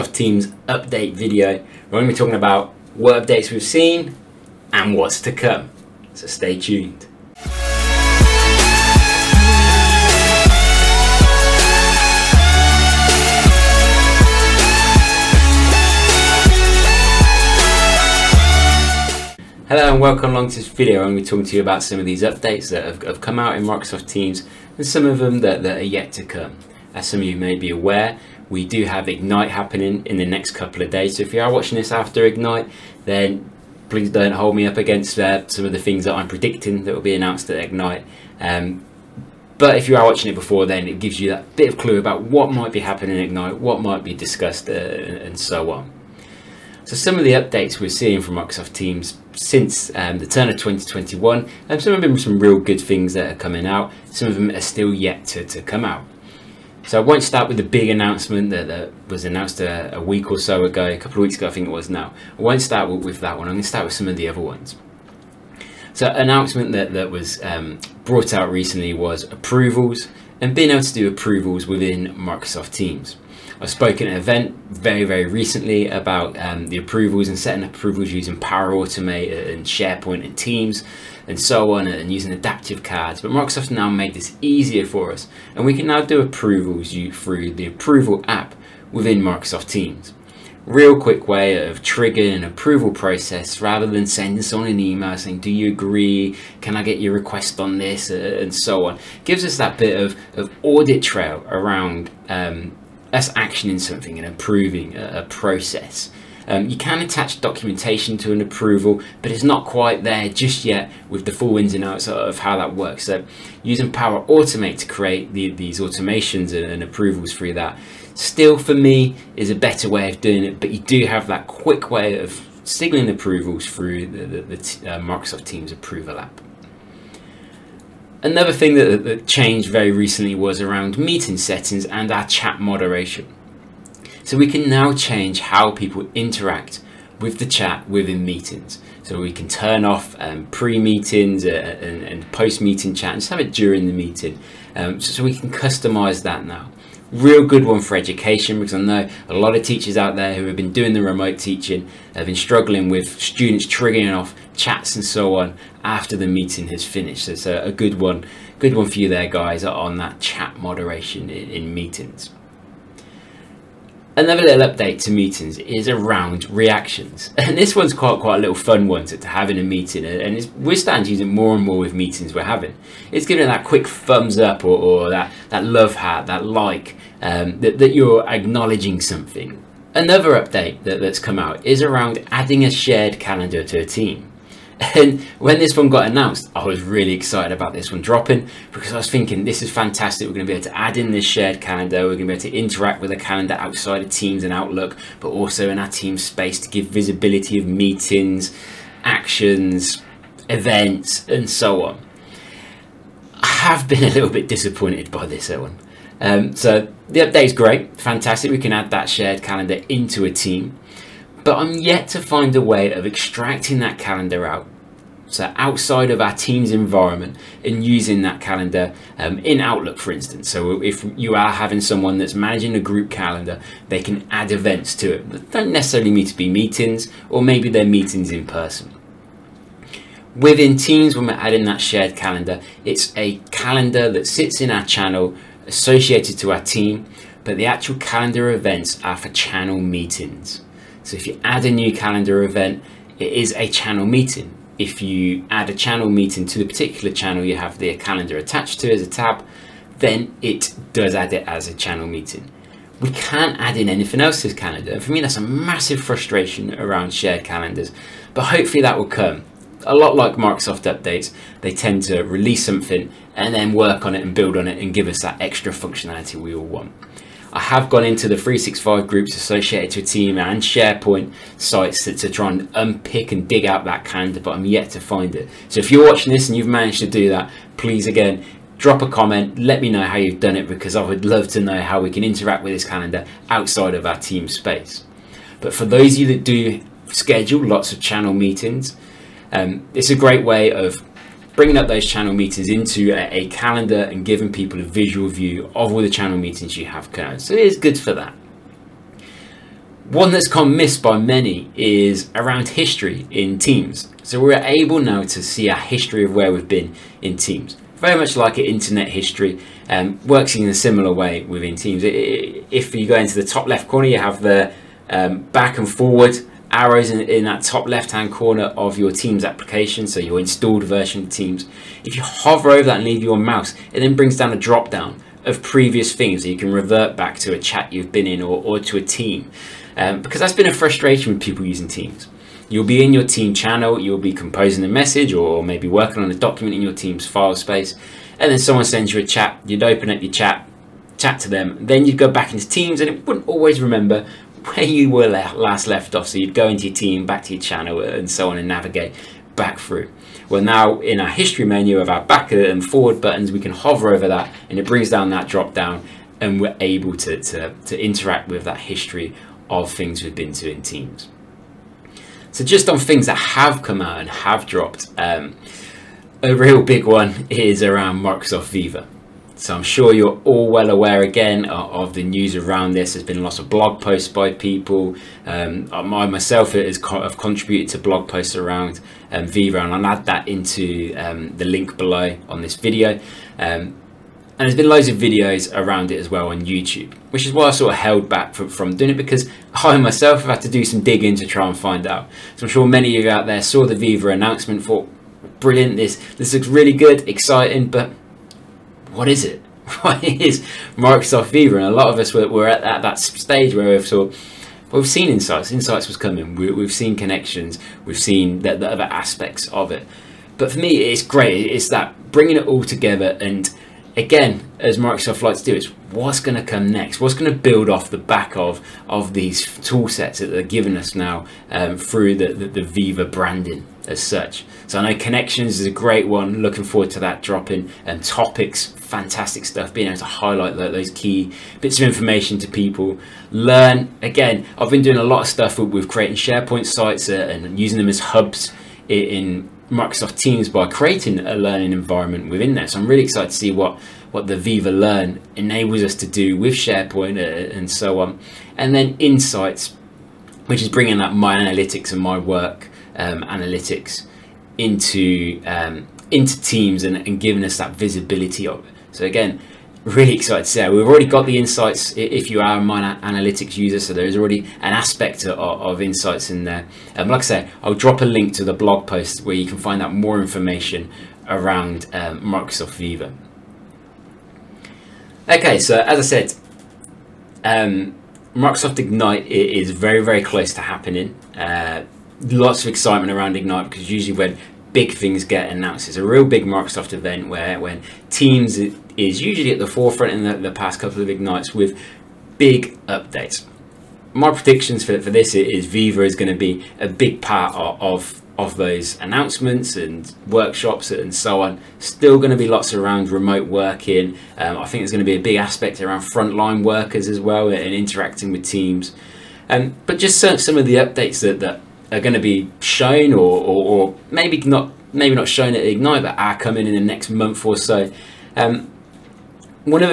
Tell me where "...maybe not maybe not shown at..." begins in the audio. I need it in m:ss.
8:34.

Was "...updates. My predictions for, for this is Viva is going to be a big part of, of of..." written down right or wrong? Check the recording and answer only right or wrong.
right.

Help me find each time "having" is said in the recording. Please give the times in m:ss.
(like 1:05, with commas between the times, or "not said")
2:52, 3:41.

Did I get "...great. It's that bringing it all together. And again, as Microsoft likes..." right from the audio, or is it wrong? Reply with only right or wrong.
right.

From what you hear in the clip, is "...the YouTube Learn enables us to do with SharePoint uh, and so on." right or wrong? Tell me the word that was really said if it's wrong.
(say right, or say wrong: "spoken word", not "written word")
wrong: "Viva", not "YouTube".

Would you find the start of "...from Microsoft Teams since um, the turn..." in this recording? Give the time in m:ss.
0:48.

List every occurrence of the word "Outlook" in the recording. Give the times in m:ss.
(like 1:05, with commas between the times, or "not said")
3:14, 3:39.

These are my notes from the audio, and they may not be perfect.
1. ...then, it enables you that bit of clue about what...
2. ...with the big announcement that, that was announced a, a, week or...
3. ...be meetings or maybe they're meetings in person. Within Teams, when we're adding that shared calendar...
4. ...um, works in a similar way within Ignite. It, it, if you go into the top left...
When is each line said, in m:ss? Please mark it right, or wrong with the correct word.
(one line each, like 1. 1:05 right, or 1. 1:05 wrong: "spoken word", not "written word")
1. 0:40 wrong: "gives", not "enables"
2. 0:57 right
3. 3:46 right
4. 5:09 wrong: "Teams", not "Ignite".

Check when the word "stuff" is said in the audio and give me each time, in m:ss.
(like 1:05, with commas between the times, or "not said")
7:09, 7:15.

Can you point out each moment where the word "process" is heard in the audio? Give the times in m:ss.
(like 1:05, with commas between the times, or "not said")
1:32, 1:45.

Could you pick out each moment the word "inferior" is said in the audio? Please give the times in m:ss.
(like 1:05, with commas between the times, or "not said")
not said.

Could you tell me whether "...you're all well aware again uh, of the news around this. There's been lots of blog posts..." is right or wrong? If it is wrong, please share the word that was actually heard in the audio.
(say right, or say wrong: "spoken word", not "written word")
right.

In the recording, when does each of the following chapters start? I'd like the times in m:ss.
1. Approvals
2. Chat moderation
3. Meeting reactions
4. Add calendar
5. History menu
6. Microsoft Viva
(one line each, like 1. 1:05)
1. 1:09
2. 2:16
3. 2:45
4. 3:05
5. 5:06
6. 6:08.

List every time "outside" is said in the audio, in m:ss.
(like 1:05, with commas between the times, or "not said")
3:13, 3:35, 4:43.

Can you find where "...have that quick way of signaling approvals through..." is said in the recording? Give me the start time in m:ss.
2:01.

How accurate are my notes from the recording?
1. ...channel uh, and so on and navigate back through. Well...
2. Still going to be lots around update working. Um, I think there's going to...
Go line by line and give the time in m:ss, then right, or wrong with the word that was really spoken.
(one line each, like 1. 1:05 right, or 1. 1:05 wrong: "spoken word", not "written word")
1. 5:47 right
2. 8:21 wrong: "remote", not "update".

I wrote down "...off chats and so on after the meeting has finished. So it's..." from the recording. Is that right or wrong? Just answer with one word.
right.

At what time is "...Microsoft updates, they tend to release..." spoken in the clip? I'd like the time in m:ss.
4:20.